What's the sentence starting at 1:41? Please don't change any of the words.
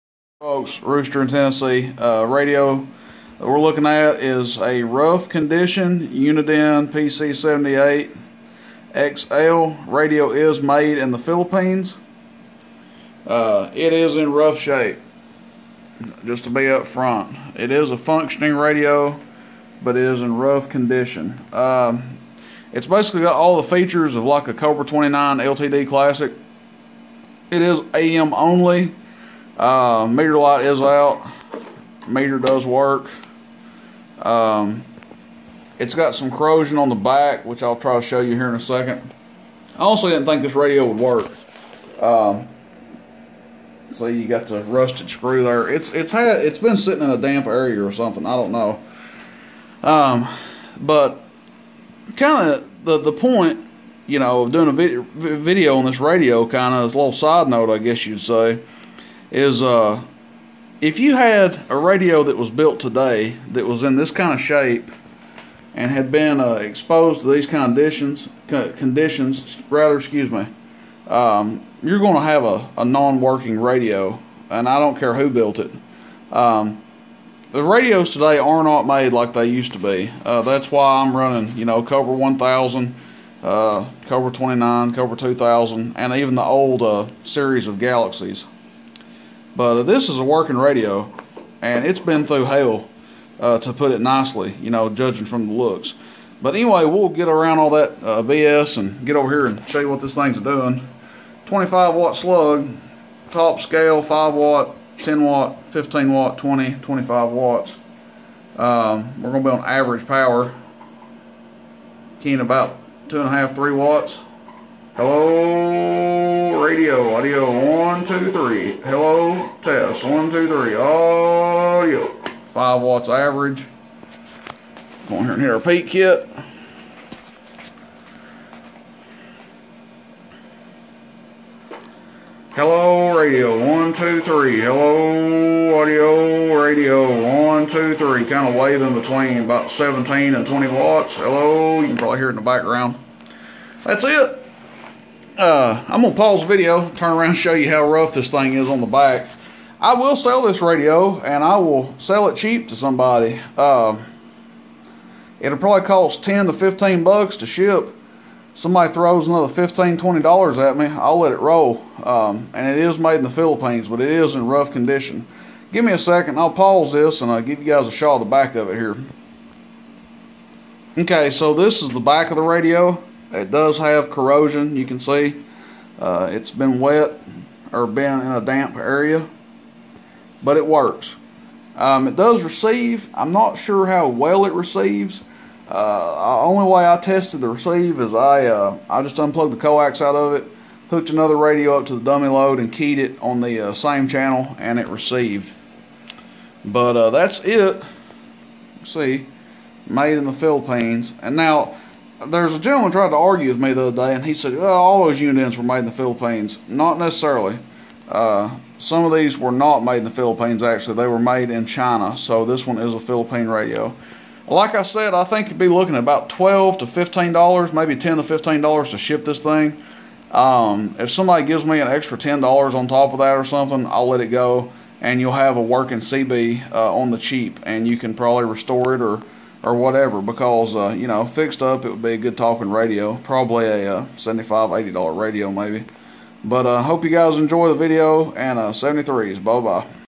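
25 watt slug, top scale, 5 watt, 10 watt, 15 watt, 20, 25 watts.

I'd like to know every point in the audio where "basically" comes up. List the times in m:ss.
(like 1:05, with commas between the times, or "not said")
0:22.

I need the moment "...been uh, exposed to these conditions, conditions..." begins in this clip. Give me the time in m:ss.
1:06.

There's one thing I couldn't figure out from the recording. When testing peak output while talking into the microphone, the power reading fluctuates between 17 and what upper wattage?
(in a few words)
20 watts.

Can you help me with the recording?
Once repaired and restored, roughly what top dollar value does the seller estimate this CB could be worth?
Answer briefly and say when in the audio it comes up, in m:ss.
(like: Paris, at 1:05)
$80, at 3:54.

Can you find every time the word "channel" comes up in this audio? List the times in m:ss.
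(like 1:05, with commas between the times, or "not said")
3:14.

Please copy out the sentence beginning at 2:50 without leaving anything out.
Okay, so this is the back of the radio.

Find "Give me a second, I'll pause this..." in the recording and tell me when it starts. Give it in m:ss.
2:45.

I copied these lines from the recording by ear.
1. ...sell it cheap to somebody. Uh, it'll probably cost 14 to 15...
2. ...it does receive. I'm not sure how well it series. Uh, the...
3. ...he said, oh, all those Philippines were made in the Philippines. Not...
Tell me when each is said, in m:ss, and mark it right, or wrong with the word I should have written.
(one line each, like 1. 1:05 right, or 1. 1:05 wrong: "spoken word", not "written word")
1. 2:31 wrong: "10", not "14"
2. 3:02 wrong: "receives", not "series"
3. 3:24 wrong: "Uniden", not "Philippines".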